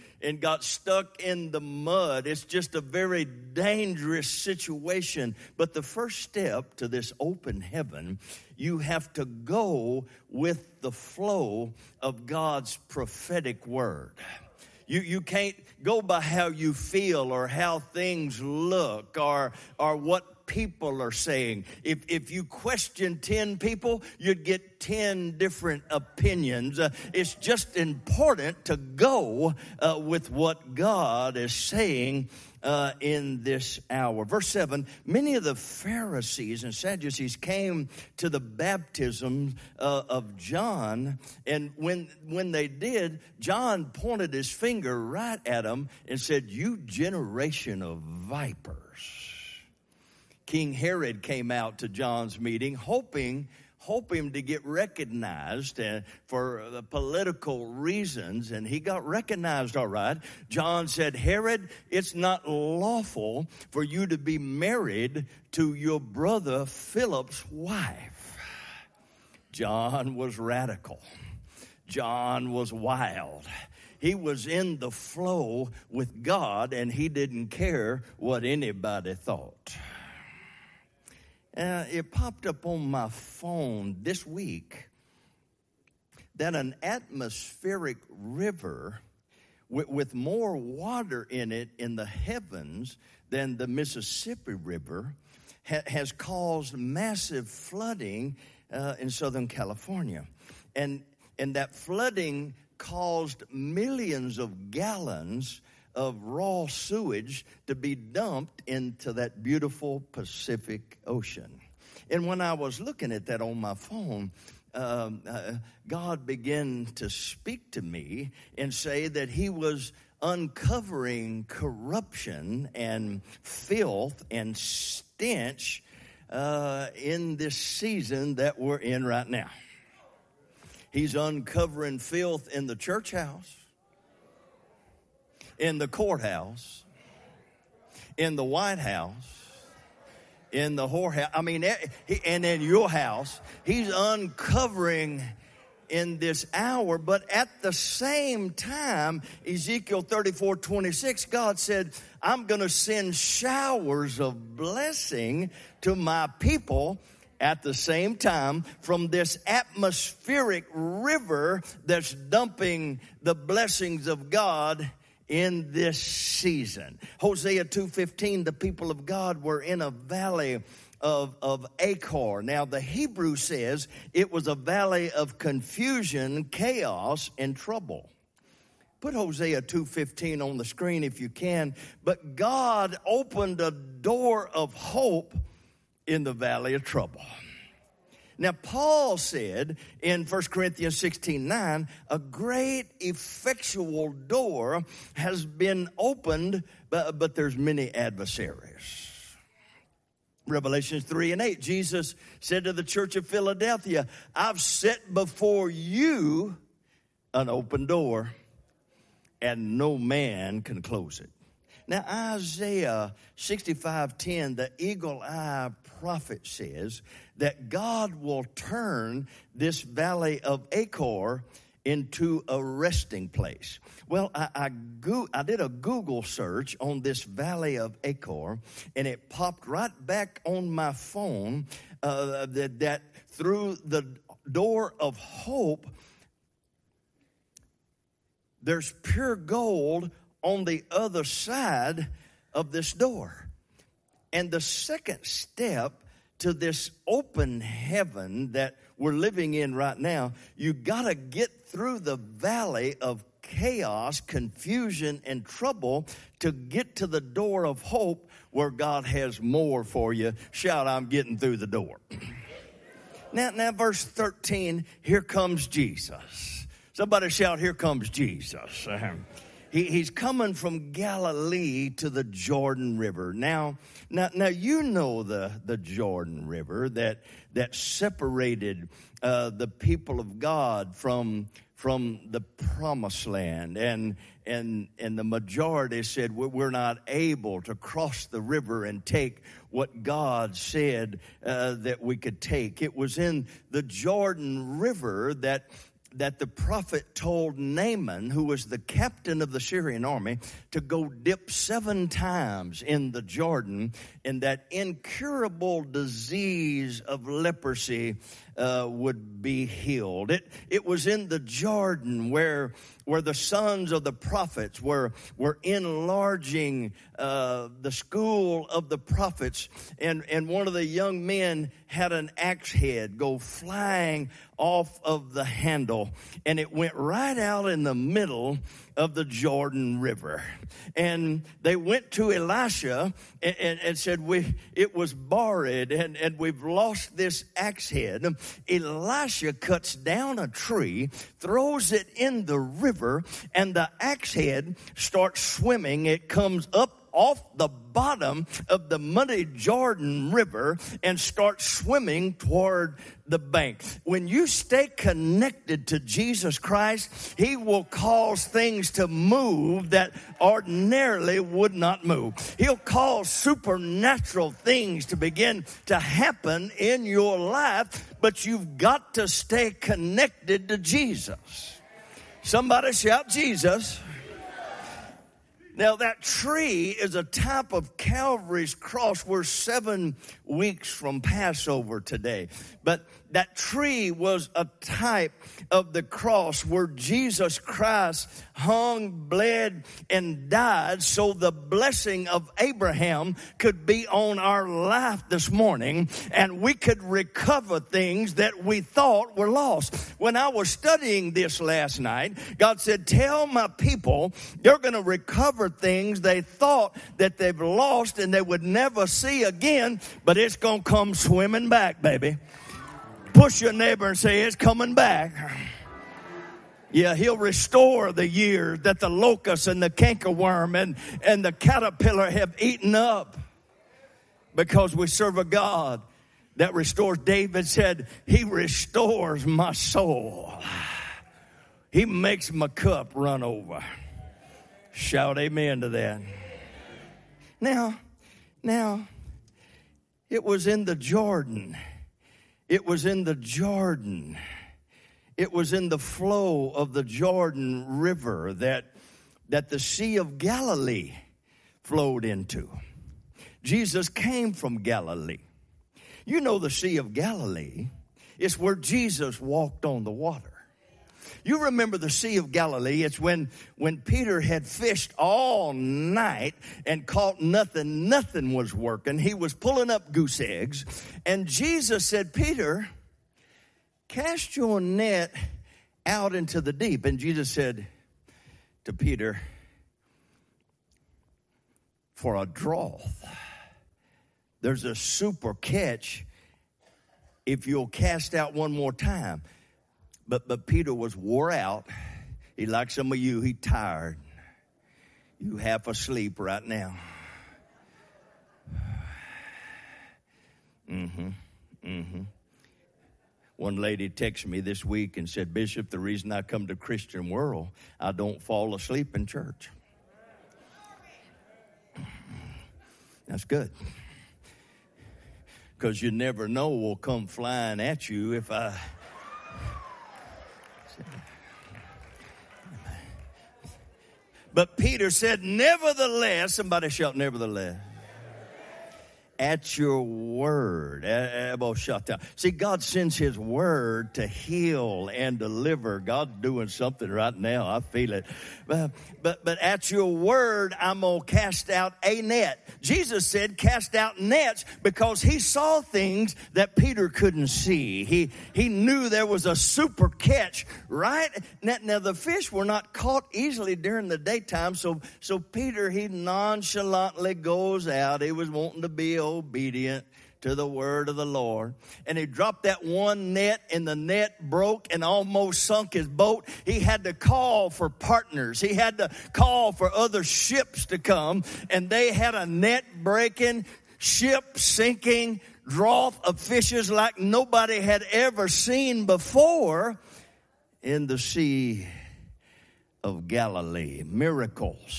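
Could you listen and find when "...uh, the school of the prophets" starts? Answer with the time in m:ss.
5:17.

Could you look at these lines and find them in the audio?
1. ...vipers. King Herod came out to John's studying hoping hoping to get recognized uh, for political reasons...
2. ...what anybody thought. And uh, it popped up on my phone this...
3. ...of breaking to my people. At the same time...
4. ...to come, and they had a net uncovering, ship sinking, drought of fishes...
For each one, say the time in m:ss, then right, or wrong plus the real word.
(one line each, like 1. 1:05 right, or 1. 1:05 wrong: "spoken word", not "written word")
1. 0:47 wrong: "meeting", not "studying"
2. 1:18 right
3. 2:34 wrong: "blessing", not "breaking"
4. 9:30 wrong: "breaking", not "uncovering".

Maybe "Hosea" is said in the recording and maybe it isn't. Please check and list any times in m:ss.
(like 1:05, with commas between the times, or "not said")
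2:47, 2:59.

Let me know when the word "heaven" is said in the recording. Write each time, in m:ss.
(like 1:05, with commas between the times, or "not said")
0:07, 1:32, 4:07.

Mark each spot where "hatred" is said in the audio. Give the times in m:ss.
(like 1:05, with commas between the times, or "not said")
not said.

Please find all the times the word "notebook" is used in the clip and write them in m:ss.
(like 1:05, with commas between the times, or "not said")
not said.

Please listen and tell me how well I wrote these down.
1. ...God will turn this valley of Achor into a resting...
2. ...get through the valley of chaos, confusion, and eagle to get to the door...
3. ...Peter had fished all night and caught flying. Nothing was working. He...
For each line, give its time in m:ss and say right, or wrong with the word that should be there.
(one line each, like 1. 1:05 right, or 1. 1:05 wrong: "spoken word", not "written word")
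1. 3:37 right
2. 4:11 wrong: "trouble", not "eagle"
3. 7:44 wrong: "nothing", not "flying".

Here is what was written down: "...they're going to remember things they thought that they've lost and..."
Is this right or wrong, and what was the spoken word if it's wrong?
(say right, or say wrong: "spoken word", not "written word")
wrong: "recover", not "remember".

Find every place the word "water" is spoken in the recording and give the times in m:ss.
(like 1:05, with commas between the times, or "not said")
1:30, 7:40.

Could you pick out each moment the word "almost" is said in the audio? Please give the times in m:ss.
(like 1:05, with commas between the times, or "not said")
9:25.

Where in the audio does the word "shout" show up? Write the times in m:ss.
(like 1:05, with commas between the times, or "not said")
4:20, 4:27, 6:12, 7:14, 8:46.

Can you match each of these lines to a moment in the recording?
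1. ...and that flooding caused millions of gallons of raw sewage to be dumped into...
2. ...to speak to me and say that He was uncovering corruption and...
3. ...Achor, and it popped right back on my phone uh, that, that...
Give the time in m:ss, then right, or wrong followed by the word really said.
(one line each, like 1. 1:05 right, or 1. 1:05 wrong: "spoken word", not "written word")
1. 1:41 right
2. 1:56 right
3. 3:48 right.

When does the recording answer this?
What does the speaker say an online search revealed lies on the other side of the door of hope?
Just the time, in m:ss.
3:59.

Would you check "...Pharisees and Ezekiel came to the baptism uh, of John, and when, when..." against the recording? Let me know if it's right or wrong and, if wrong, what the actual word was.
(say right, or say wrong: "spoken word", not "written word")
wrong: "Sadducees", not "Ezekiel".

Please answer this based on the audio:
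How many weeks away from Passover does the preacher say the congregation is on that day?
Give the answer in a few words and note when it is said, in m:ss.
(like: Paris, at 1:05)
7, at 6:19.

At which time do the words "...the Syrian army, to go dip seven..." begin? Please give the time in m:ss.
4:59.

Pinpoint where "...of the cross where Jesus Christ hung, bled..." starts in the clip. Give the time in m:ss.
6:25.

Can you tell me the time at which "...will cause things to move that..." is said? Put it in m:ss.
5:57.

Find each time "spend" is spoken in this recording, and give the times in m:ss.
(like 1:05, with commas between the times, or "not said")
not said.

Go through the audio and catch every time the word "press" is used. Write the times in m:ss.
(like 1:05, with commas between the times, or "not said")
not said.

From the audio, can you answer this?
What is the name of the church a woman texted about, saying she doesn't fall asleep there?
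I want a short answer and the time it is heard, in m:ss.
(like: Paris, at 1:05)
Christian World, at 8:26.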